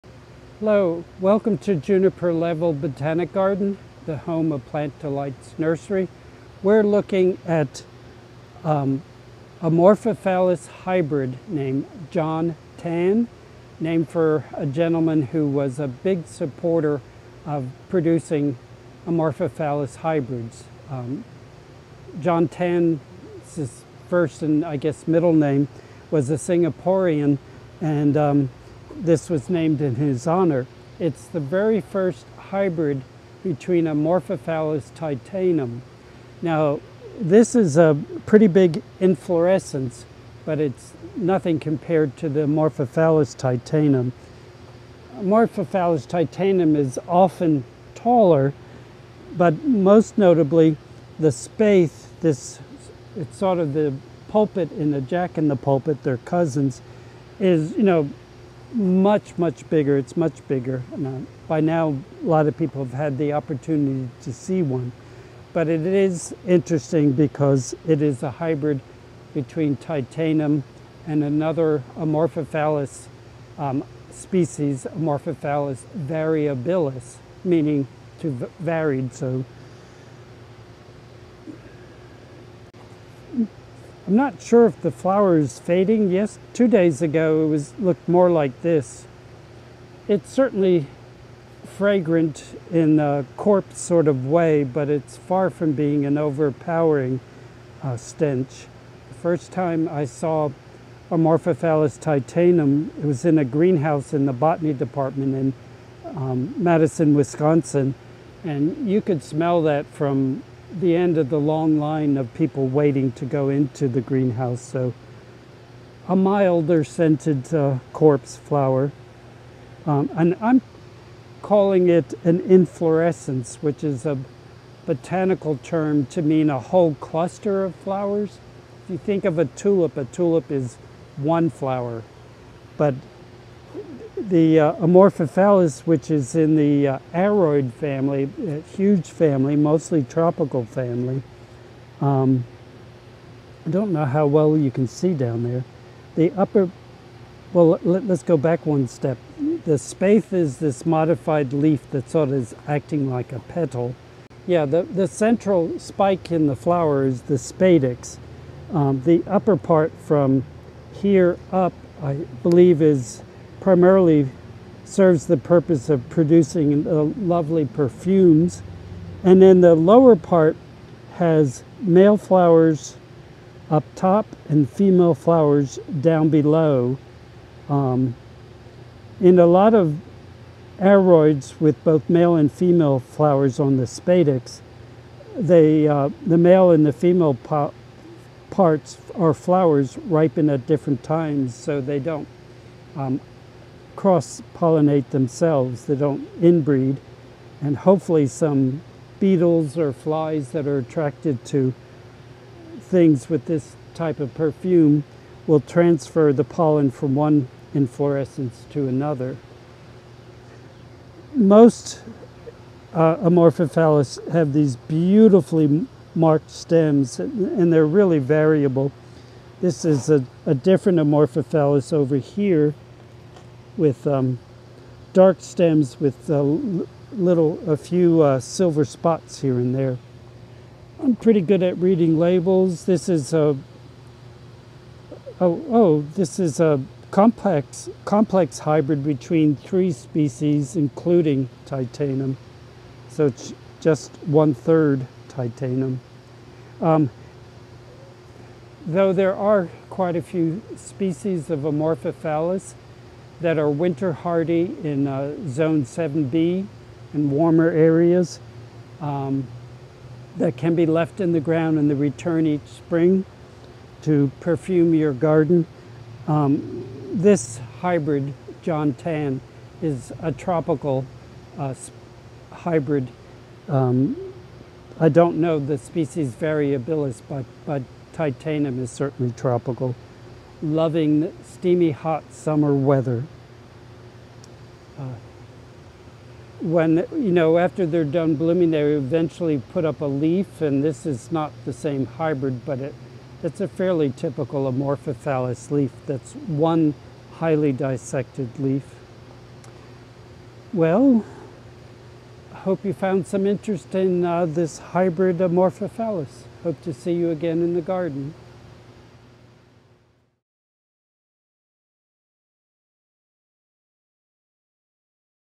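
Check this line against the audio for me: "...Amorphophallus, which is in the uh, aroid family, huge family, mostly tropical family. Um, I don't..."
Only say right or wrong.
right.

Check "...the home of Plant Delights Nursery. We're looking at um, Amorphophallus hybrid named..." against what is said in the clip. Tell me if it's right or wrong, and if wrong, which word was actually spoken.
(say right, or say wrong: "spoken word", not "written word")
right.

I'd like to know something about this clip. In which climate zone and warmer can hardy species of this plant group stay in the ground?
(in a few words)
Zone 7B.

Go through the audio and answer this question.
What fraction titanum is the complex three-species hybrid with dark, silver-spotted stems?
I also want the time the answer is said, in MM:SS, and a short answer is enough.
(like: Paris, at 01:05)
One third, at 04:04.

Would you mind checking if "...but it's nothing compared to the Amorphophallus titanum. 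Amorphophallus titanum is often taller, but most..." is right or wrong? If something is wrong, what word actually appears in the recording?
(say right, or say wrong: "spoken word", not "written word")
right.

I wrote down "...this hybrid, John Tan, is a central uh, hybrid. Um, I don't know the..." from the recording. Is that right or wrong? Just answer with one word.
wrong.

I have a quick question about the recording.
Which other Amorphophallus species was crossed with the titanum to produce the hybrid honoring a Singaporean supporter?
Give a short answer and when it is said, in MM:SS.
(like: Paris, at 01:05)
Amorphophallus variabilis, at 01:14.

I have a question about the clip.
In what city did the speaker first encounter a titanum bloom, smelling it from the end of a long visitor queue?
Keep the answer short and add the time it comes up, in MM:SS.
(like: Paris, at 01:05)
Madison, Wisconsin, at 01:46.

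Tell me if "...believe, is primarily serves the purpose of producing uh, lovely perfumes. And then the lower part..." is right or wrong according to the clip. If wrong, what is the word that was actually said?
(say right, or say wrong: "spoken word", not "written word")
right.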